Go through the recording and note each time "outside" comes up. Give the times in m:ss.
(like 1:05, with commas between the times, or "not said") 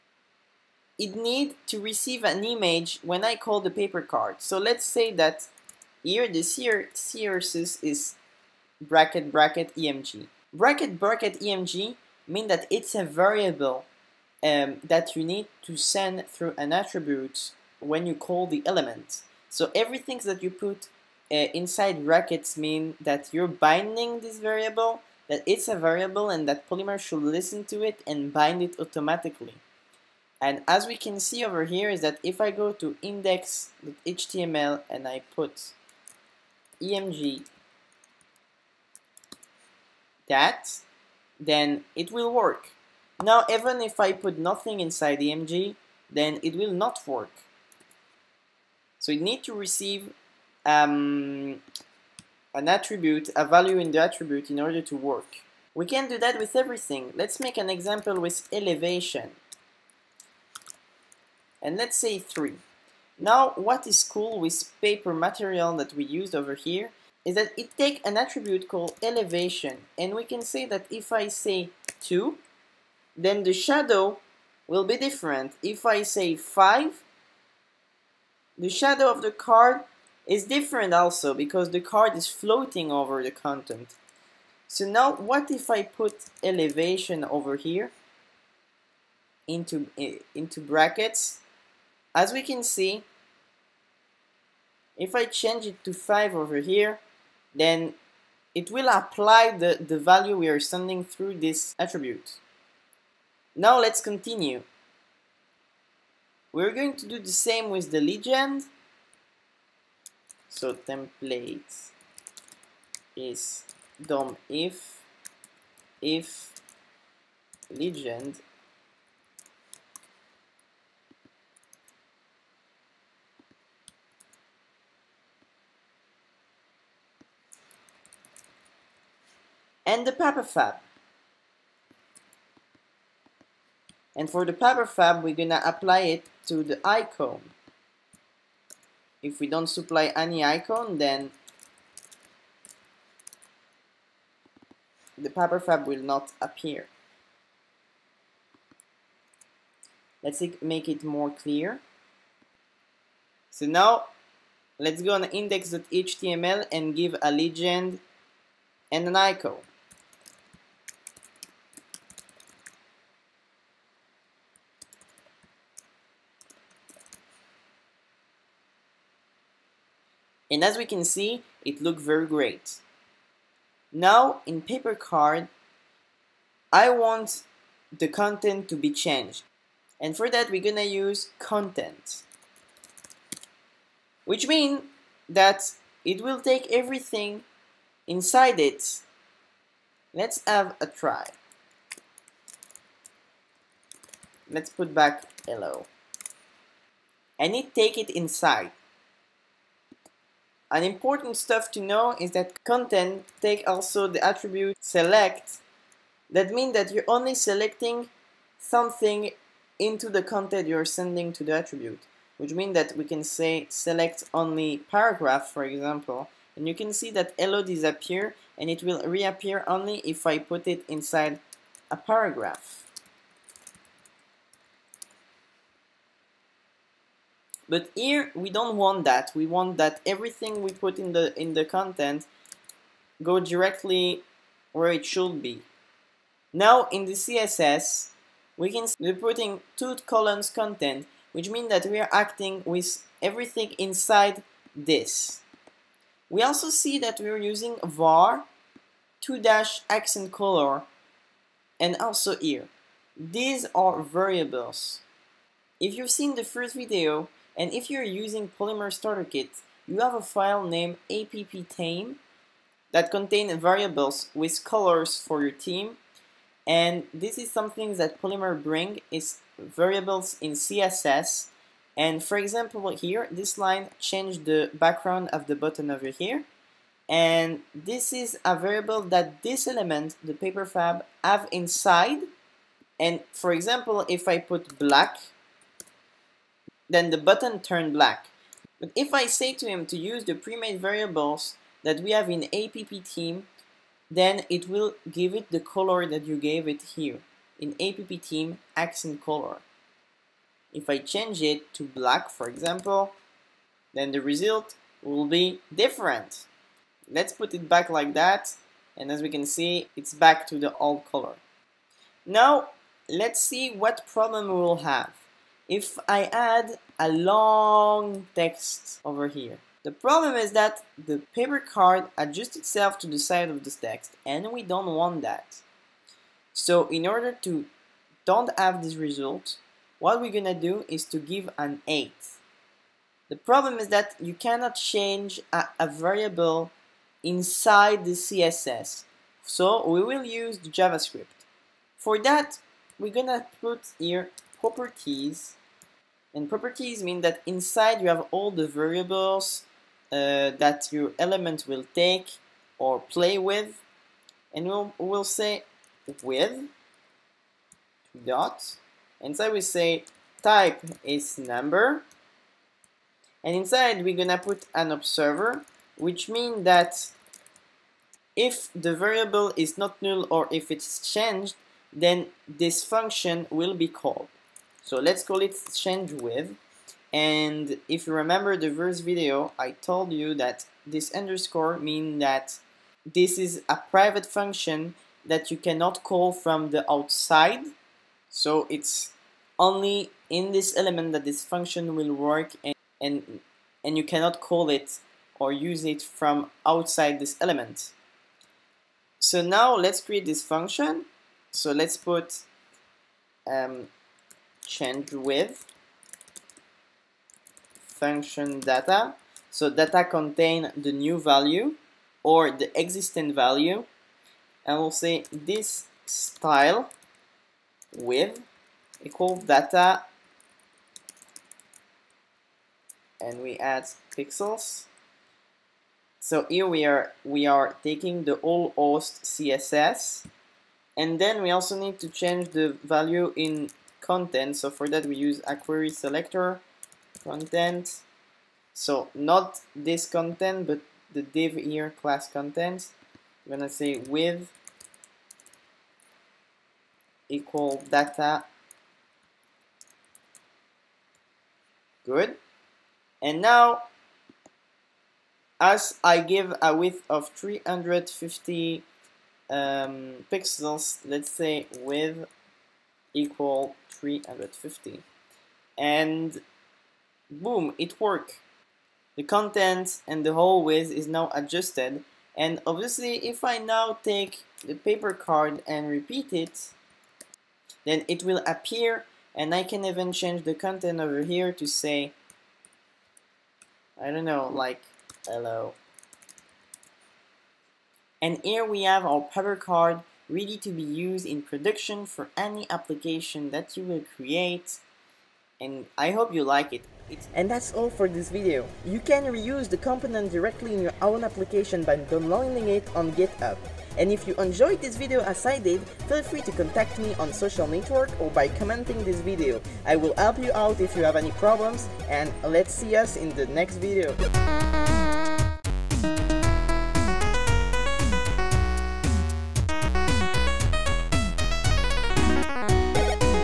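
6:26, 6:36.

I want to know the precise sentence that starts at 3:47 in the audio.
But here we don't want that.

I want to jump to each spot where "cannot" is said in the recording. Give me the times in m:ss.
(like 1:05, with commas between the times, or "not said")
5:34, 6:25, 6:34.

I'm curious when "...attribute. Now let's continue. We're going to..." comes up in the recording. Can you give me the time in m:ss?
1:41.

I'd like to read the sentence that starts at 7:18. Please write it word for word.
So not this content, but the div here class content.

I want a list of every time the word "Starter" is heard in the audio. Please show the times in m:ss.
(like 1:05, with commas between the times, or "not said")
4:18.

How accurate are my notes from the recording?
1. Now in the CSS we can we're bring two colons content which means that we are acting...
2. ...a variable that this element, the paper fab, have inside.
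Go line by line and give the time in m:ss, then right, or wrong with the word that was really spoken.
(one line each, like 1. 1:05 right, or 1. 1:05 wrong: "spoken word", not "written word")
1. 3:56 wrong: "putting", not "bring"
2. 4:38 right.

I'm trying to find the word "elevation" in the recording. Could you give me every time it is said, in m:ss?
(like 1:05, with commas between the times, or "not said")
0:58, 1:09, 1:26.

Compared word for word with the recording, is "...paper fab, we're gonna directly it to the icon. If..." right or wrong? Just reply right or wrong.
wrong.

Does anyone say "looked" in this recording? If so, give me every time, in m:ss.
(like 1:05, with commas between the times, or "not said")
2:51.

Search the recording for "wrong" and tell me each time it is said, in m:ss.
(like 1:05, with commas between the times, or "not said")
not said.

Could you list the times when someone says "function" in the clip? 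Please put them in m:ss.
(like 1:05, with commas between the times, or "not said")
6:12, 6:24, 6:31, 6:40, 6:47.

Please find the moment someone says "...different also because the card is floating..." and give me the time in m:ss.
1:20.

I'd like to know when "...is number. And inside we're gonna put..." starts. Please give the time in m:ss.
6:01.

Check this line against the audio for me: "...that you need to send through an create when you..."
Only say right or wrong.
wrong.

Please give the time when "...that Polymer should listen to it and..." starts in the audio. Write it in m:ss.
0:26.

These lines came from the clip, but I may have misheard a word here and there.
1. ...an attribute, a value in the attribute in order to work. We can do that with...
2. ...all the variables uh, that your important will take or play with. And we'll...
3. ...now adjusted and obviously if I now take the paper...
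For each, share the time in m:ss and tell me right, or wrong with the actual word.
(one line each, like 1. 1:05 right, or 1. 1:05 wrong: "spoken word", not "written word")
1. 0:52 right
2. 5:48 wrong: "element", not "important"
3. 7:51 right.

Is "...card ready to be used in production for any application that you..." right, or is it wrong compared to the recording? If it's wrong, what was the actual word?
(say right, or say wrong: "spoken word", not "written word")
right.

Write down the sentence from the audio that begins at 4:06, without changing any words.
We also see that we're using var 2 dash accent color and also here.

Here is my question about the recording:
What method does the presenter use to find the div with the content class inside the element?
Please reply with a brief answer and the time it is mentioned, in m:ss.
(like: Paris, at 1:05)
query selector, at 7:15.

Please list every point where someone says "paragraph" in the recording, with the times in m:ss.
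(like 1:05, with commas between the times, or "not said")
3:34, 3:41.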